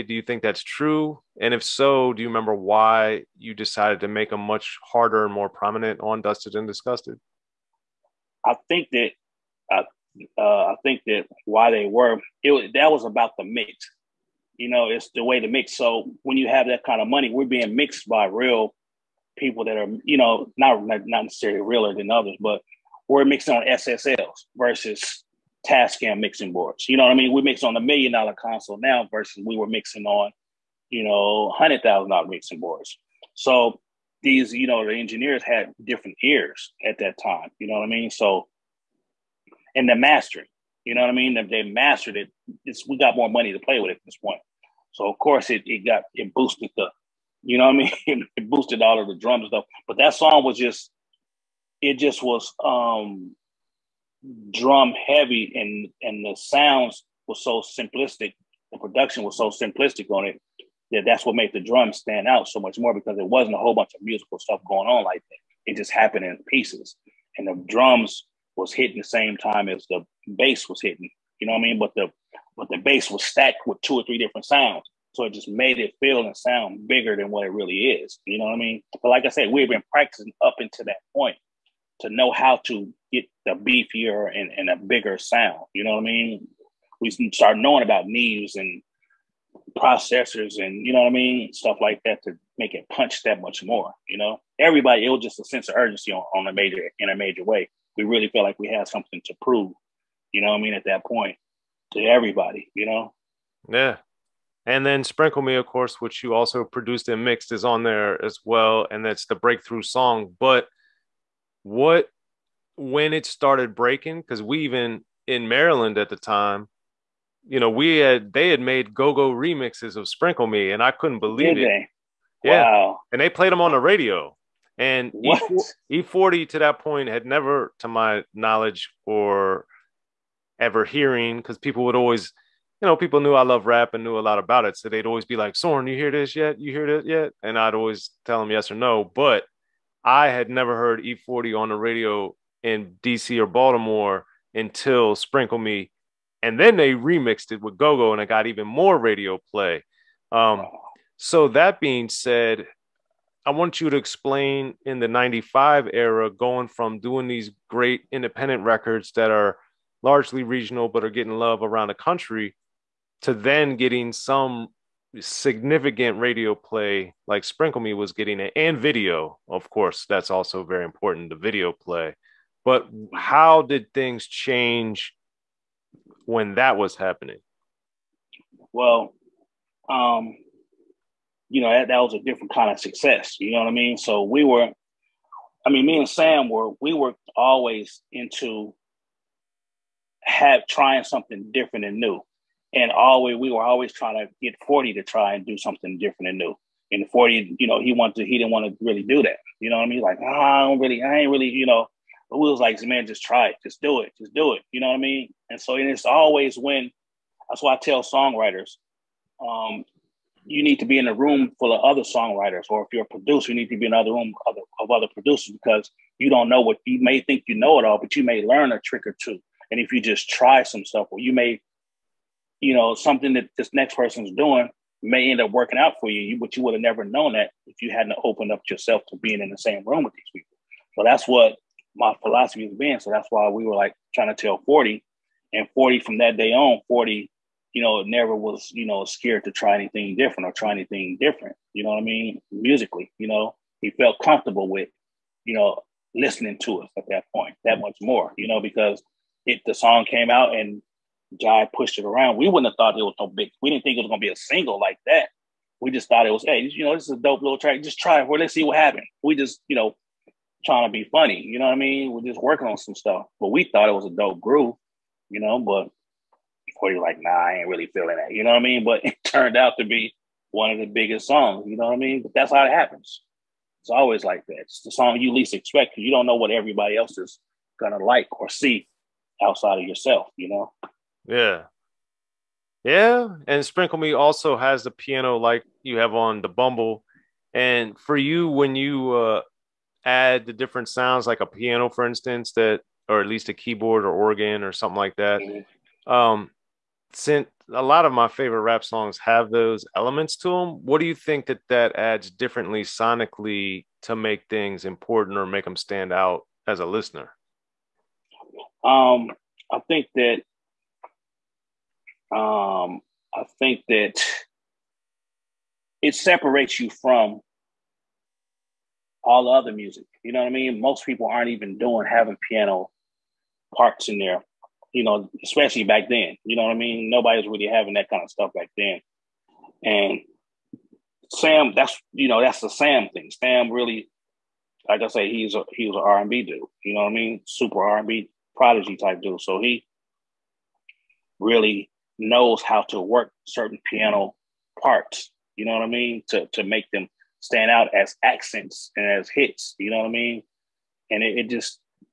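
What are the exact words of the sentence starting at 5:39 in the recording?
So he really knows how to work certain piano parts.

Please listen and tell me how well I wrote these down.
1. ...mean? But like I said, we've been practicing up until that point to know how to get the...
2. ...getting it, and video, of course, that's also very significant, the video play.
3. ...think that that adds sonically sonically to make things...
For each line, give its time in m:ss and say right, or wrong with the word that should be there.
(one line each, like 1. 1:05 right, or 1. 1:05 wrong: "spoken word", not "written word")
1. 1:18 right
2. 2:48 wrong: "important", not "significant"
3. 5:01 wrong: "differently", not "sonically".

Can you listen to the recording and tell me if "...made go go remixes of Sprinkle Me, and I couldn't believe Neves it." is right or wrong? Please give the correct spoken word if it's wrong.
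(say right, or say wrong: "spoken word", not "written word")
wrong: "Did", not "Neves".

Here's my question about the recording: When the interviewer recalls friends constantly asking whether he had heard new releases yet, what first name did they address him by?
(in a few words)
Soren.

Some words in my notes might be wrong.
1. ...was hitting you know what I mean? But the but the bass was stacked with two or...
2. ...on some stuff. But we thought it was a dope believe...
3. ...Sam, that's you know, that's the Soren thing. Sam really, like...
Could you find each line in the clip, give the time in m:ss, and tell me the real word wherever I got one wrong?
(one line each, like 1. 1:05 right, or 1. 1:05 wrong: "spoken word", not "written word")
1. 1:10 right
2. 4:22 wrong: "groove", not "believe"
3. 5:31 wrong: "Sam", not "Soren".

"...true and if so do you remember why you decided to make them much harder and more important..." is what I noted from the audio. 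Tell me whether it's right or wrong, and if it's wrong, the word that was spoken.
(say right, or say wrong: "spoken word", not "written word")
wrong: "prominent", not "important".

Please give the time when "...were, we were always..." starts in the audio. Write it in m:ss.
3:06.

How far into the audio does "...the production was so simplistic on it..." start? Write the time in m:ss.
0:58.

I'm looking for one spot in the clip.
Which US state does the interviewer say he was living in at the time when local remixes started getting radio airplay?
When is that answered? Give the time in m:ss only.
1:55.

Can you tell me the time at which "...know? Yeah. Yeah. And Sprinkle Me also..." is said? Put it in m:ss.
4:40.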